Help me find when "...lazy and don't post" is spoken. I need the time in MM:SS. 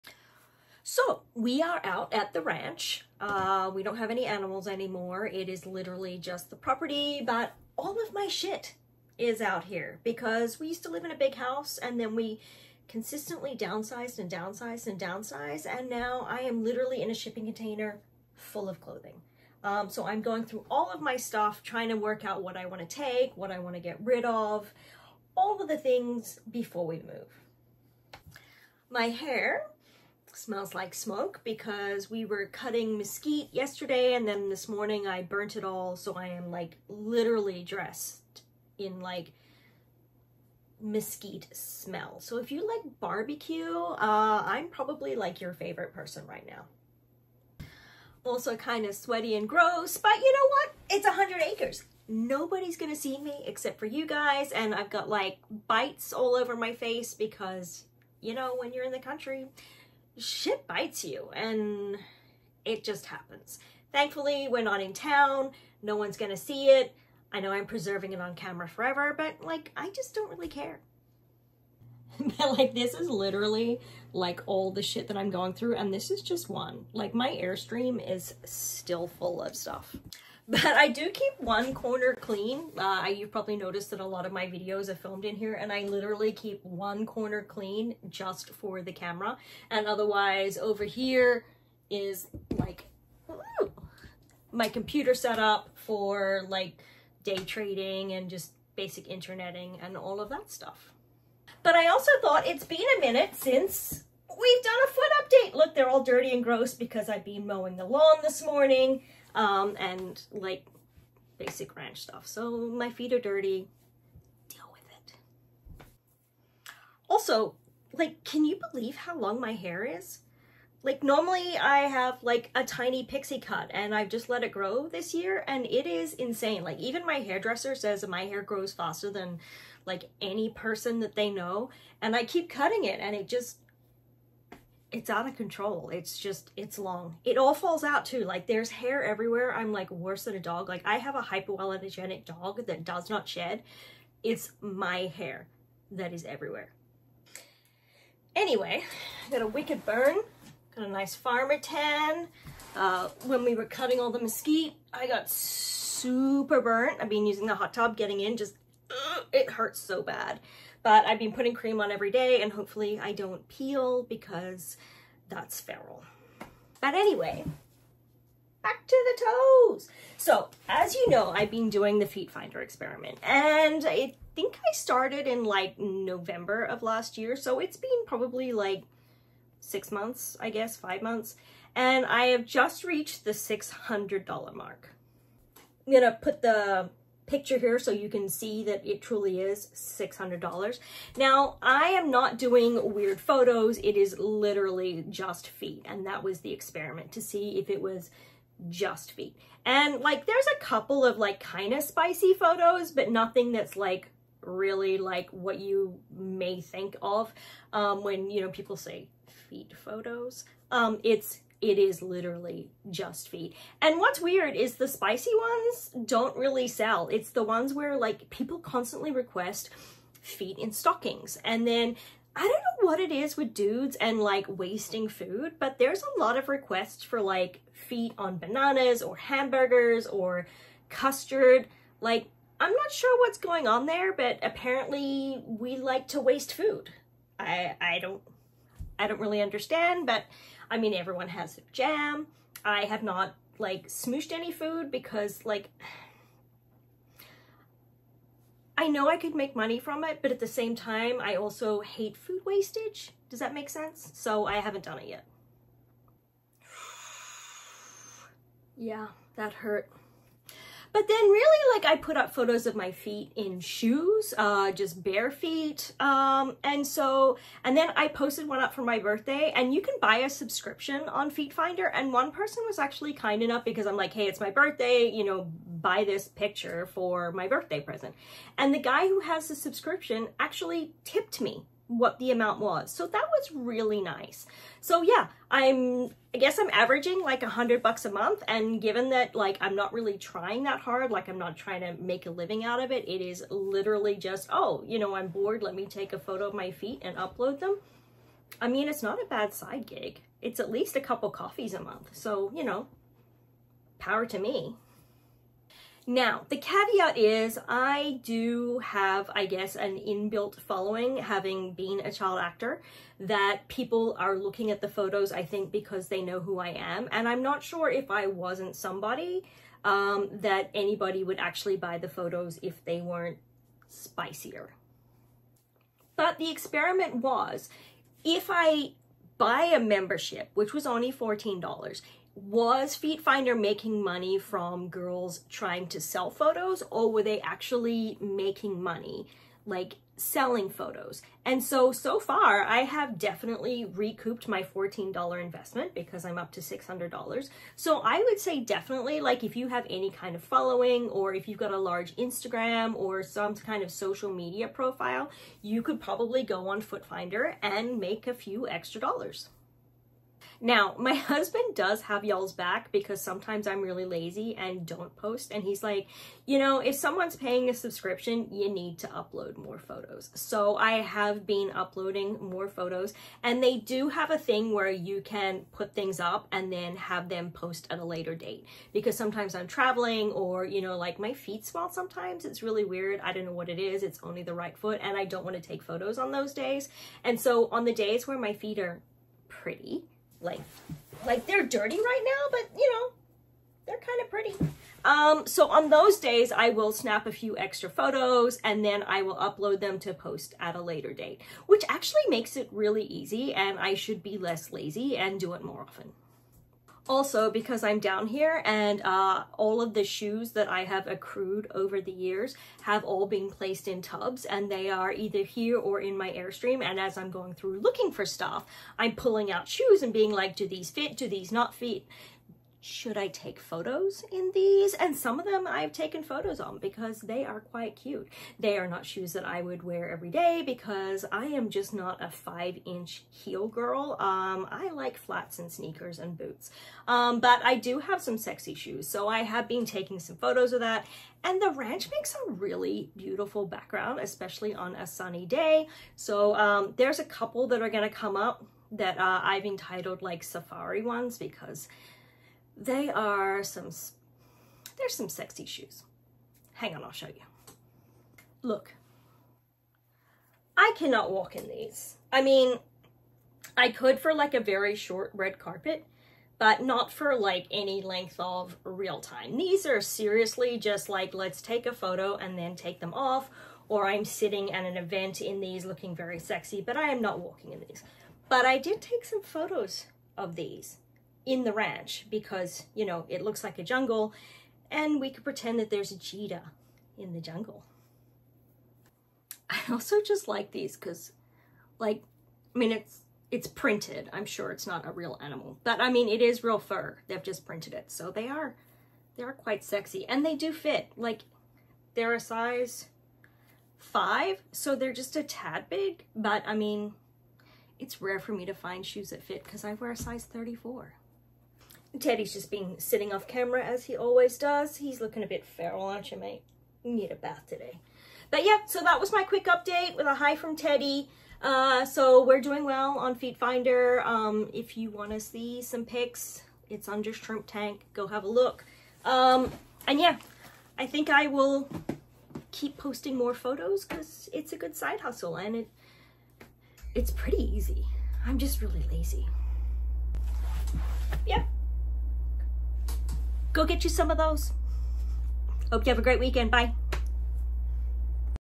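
06:04.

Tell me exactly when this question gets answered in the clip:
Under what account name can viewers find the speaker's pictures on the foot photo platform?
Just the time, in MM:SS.
08:47.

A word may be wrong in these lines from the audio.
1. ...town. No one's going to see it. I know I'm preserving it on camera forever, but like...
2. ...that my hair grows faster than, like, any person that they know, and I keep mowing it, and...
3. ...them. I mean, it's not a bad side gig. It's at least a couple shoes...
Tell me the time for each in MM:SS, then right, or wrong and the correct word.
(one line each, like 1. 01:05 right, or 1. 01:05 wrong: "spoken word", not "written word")
1. 01:04 right
2. 02:08 wrong: "cutting", not "mowing"
3. 04:57 wrong: "coffees", not "shoes".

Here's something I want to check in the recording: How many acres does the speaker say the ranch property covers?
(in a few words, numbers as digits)
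100.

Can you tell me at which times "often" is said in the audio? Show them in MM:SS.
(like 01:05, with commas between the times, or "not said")
06:45.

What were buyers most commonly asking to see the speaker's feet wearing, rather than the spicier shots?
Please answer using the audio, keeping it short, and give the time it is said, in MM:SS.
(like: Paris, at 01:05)
stockings, at 03:40.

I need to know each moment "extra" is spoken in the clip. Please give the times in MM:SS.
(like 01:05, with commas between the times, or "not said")
05:58, 06:37.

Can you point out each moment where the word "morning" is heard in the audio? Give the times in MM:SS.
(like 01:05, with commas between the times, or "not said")
00:34, 01:48.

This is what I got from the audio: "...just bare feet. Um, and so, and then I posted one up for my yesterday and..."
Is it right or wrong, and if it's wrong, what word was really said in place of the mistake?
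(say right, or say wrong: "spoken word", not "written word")
wrong: "birthday", not "yesterday".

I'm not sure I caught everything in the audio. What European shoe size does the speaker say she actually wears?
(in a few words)
34.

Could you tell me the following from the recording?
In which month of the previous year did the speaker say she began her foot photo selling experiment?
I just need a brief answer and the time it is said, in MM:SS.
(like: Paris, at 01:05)
November, at 02:55.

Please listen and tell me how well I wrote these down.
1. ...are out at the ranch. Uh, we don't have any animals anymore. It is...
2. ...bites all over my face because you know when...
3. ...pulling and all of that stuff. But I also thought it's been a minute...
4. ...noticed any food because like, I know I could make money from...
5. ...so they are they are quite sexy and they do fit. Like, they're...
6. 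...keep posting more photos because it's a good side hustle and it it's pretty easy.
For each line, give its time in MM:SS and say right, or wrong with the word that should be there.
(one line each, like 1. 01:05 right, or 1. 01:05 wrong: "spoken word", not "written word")
1. 00:01 right
2. 00:55 right
3. 01:39 wrong: "interneting", not "pulling"
4. 04:03 wrong: "smooshed", not "noticed"
5. 08:18 right
6. 08:52 right.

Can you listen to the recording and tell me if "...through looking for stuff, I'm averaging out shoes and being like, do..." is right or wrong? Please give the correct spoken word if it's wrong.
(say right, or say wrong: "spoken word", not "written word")
wrong: "pulling", not "averaging".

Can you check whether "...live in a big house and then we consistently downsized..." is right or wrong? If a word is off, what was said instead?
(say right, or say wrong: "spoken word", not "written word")
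right.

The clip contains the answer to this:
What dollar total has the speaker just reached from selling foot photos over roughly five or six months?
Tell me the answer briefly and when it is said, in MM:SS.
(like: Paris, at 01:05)
$600, at 03:03.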